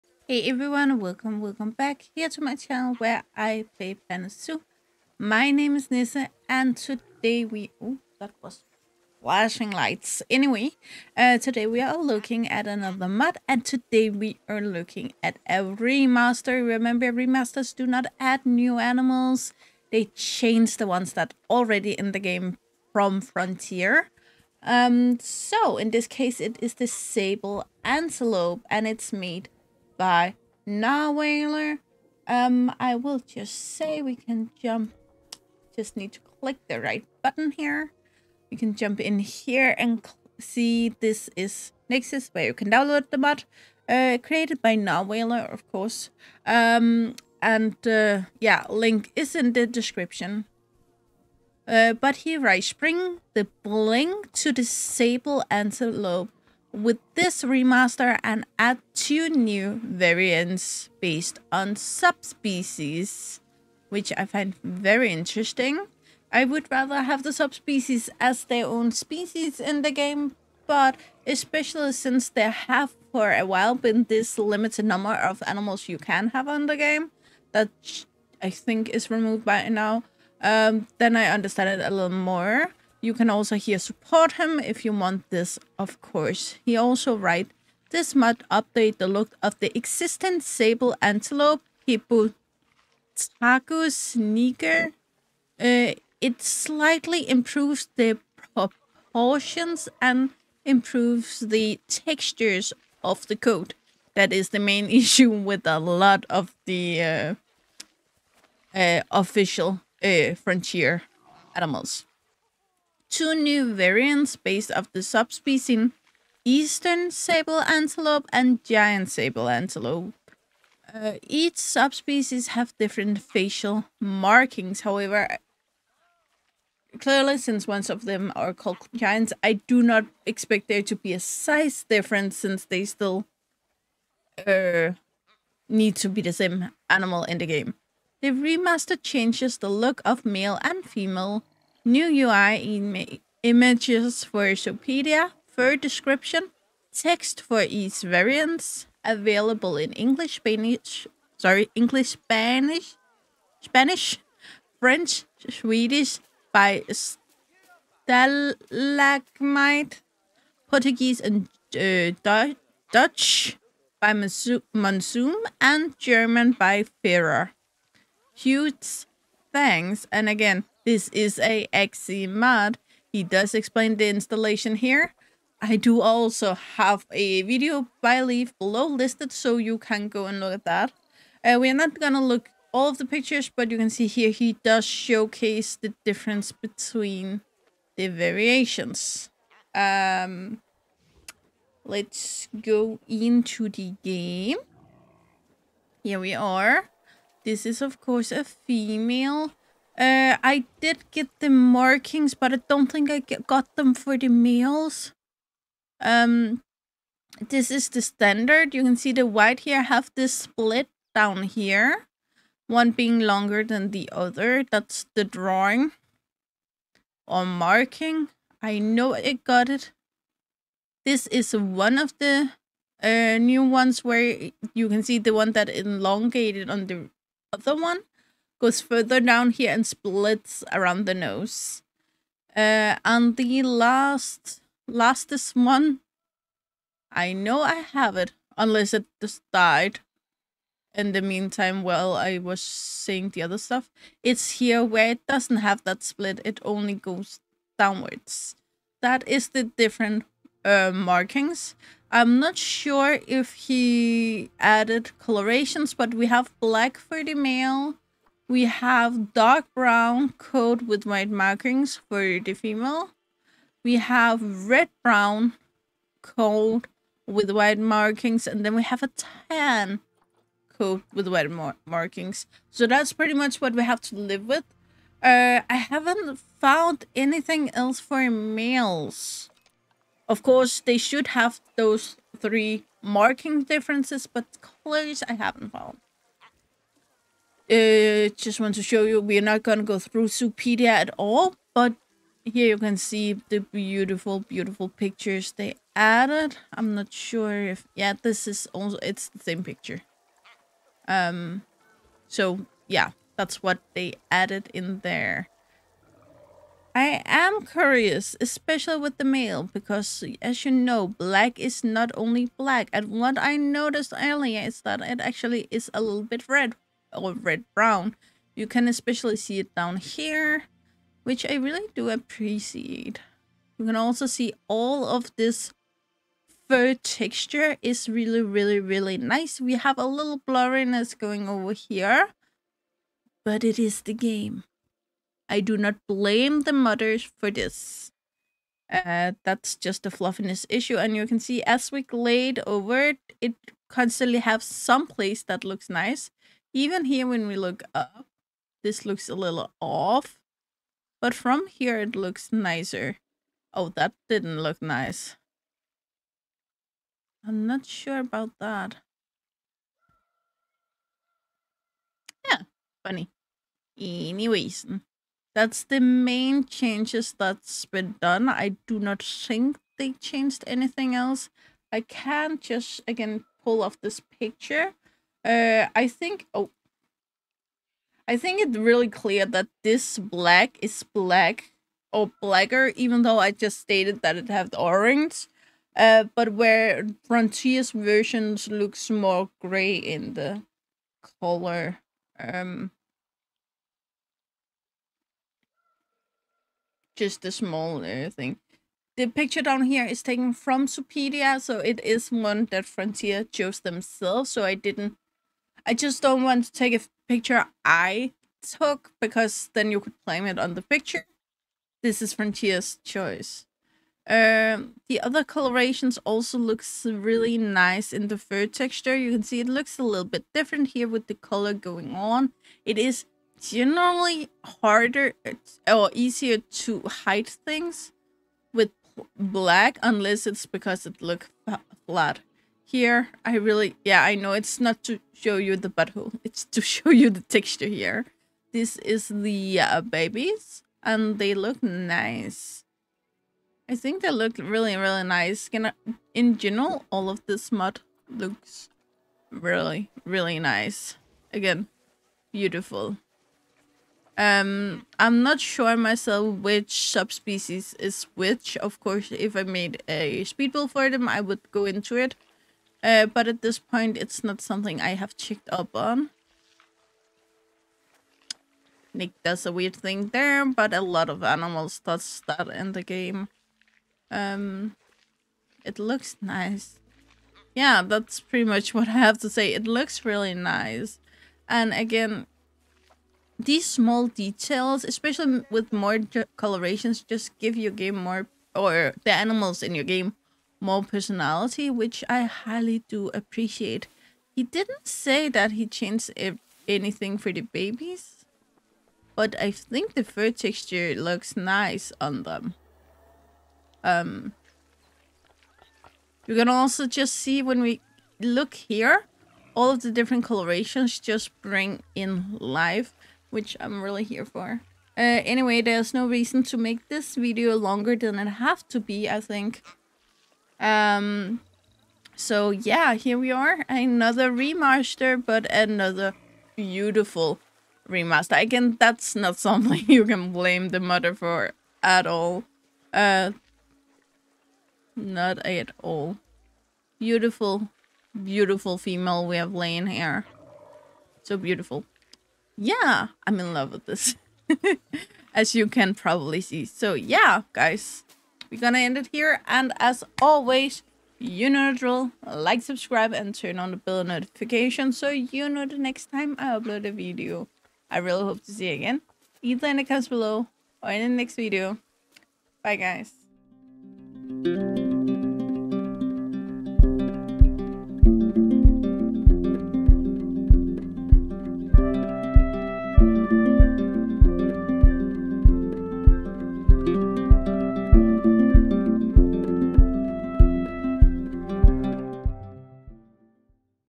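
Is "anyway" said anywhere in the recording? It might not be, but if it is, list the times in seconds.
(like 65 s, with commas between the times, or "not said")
10 s, 363 s, 515 s.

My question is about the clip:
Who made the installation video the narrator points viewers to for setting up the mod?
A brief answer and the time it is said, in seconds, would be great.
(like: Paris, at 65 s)
Leaf, at 178 s.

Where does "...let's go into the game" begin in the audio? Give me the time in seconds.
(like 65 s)
191 s.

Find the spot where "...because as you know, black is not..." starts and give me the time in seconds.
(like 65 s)
309 s.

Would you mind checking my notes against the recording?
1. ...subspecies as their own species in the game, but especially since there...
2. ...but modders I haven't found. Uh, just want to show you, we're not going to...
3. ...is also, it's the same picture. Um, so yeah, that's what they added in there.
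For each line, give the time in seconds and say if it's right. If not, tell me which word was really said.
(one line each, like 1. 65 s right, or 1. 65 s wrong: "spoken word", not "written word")
1. 67 s right
2. 284 s wrong: "colors", not "modders"
3. 298 s right.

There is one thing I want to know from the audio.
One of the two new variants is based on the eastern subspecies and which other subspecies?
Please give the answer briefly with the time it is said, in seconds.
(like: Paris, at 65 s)
Giant sable antelope, at 118 s.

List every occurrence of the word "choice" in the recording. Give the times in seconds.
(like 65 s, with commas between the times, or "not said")
413 s.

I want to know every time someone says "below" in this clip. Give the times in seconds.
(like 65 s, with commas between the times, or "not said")
178 s, 560 s.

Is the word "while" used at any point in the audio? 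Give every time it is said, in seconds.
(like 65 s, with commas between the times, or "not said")
73 s, 241 s.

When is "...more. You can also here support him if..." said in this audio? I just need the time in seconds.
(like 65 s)
82 s.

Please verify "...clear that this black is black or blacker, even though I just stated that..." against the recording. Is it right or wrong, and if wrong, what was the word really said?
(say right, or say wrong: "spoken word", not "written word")
right.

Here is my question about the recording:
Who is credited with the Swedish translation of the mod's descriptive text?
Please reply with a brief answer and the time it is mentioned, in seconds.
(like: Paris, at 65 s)
Stalagmite, at 158 s.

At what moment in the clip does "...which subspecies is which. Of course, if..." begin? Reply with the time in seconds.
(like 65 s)
456 s.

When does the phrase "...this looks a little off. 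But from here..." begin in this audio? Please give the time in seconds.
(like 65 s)
348 s.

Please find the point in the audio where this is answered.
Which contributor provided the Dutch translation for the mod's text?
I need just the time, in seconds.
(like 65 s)
164 s.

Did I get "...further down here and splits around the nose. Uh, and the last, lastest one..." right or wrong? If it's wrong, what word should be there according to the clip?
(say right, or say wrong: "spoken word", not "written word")
right.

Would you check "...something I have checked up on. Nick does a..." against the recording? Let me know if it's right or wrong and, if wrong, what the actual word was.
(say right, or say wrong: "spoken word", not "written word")
right.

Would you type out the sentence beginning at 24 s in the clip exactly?
Um, so in this case it is the sable antelope and it's made by.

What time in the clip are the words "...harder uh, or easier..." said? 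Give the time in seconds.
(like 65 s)
424 s.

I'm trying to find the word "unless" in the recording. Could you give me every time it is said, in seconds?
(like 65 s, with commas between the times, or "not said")
238 s, 430 s.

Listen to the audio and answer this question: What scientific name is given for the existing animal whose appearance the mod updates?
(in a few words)
Hippotragus niger.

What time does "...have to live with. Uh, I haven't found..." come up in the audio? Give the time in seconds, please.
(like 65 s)
273 s.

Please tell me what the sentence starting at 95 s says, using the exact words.
Uh, it slightly improves the proportions and improves the textures of the coat.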